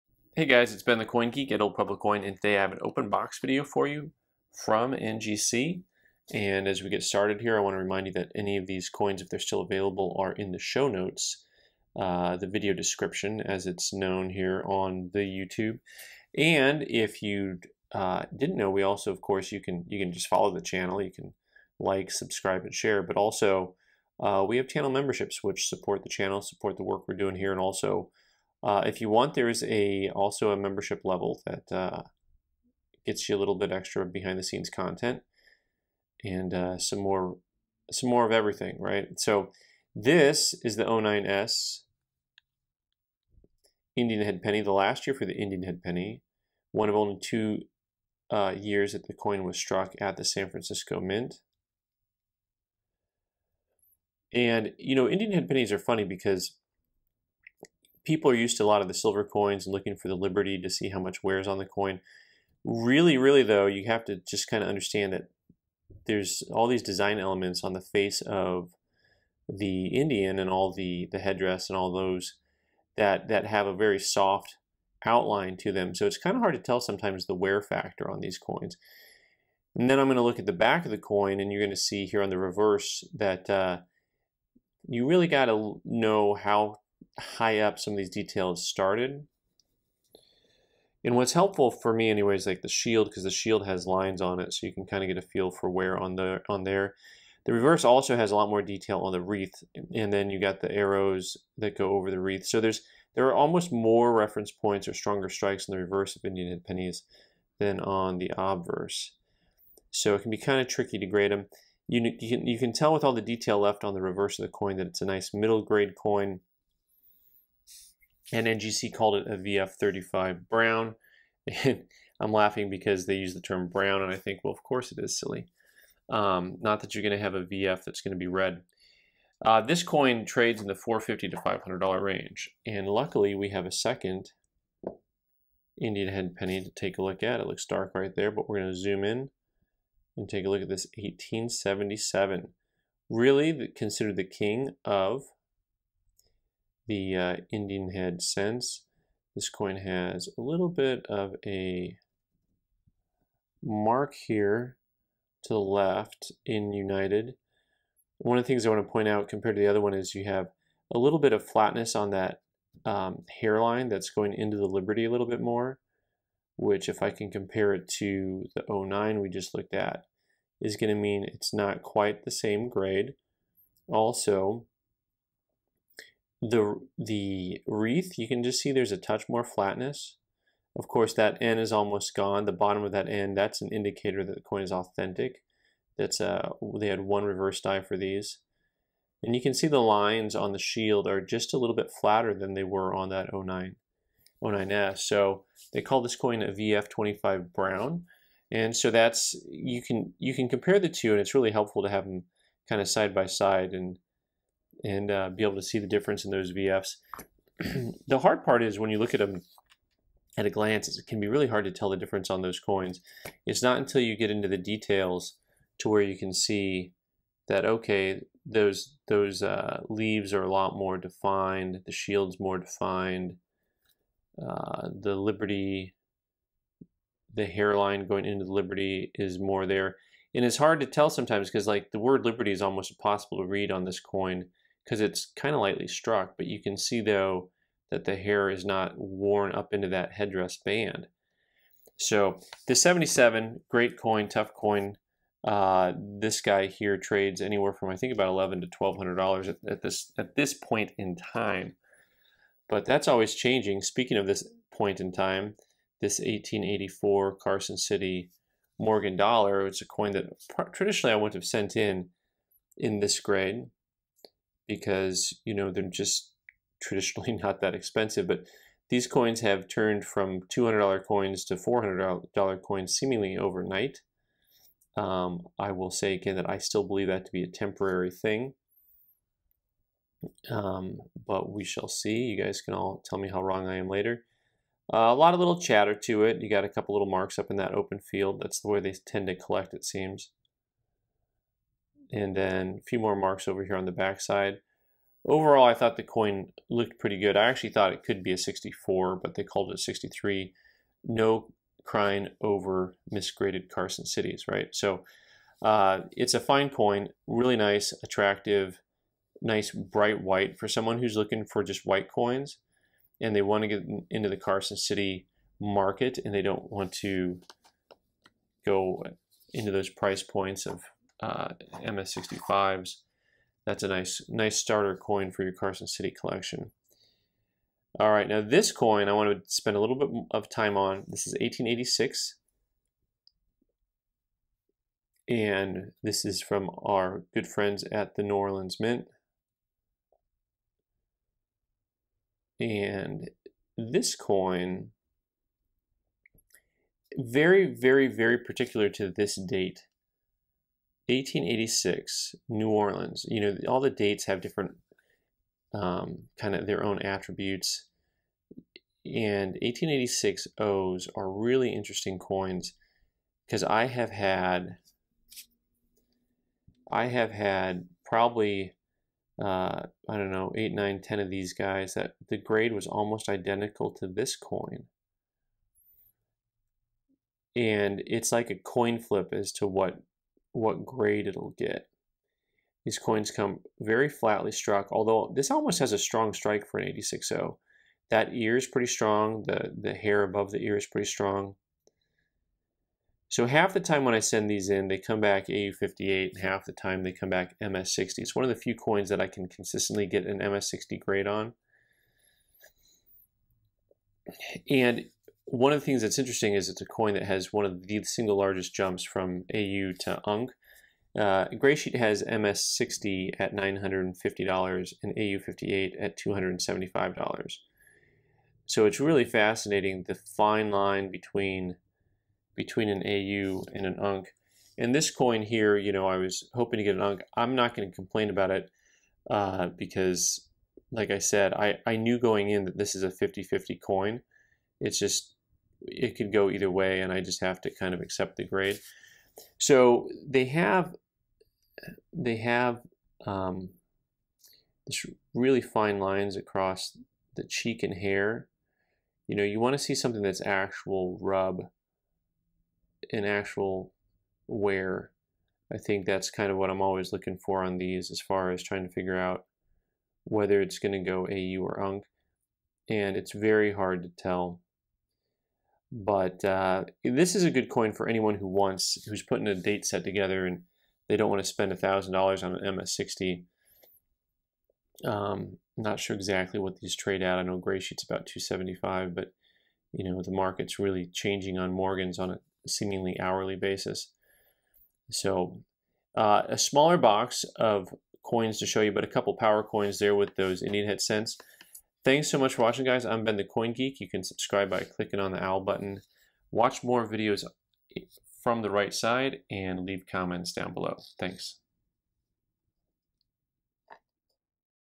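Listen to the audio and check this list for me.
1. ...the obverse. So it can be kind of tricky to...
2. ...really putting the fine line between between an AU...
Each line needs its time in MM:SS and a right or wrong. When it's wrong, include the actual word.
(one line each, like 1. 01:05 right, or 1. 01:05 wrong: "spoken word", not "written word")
1. 01:48 right
2. 06:59 wrong: "fascinating", not "putting".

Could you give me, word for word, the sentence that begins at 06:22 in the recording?
These coins come very flatly struck, although this almost has a strong strike for an 86.0.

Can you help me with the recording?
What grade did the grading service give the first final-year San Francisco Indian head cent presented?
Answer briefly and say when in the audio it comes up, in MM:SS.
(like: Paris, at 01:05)
VF35 brown, at 01:59.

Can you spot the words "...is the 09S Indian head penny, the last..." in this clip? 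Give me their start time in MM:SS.
00:40.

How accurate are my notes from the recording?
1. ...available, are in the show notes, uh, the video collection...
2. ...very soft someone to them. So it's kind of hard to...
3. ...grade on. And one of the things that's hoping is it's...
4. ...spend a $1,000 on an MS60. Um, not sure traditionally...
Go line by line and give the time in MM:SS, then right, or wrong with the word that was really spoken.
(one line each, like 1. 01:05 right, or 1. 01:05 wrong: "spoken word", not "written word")
1. 00:09 wrong: "description", not "collection"
2. 01:13 wrong: "outline", not "someone"
3. 06:40 wrong: "interesting", not "hoping"
4. 07:51 wrong: "exactly", not "traditionally".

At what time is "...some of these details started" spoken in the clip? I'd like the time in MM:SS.
01:27.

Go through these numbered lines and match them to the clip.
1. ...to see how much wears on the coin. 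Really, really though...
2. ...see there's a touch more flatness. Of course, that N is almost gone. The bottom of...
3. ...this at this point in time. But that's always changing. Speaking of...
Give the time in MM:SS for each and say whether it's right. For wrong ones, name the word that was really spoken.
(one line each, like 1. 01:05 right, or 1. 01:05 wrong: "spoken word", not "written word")
1. 01:00 right
2. 02:58 right
3. 04:09 right.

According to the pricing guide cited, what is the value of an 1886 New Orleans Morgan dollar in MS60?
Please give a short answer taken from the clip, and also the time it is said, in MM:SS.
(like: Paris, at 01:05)
$950, at 06:53.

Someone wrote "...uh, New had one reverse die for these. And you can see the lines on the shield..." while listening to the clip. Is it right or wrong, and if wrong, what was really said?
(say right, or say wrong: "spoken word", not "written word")
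wrong: "They", not "New".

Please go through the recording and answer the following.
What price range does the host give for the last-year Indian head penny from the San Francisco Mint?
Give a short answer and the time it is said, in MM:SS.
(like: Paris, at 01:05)
$450 to $500, at 02:10.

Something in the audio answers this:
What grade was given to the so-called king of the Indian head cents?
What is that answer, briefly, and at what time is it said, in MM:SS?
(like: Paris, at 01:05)
VF25 Brown, at 03:16.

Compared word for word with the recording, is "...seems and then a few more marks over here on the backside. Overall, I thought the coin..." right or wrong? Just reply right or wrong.
right.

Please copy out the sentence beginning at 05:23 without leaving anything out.
That's a nice, nice starter coin for your Carson City collection.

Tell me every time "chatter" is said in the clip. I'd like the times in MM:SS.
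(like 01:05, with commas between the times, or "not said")
04:45.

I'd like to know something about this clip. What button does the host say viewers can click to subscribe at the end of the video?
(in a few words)
owl button.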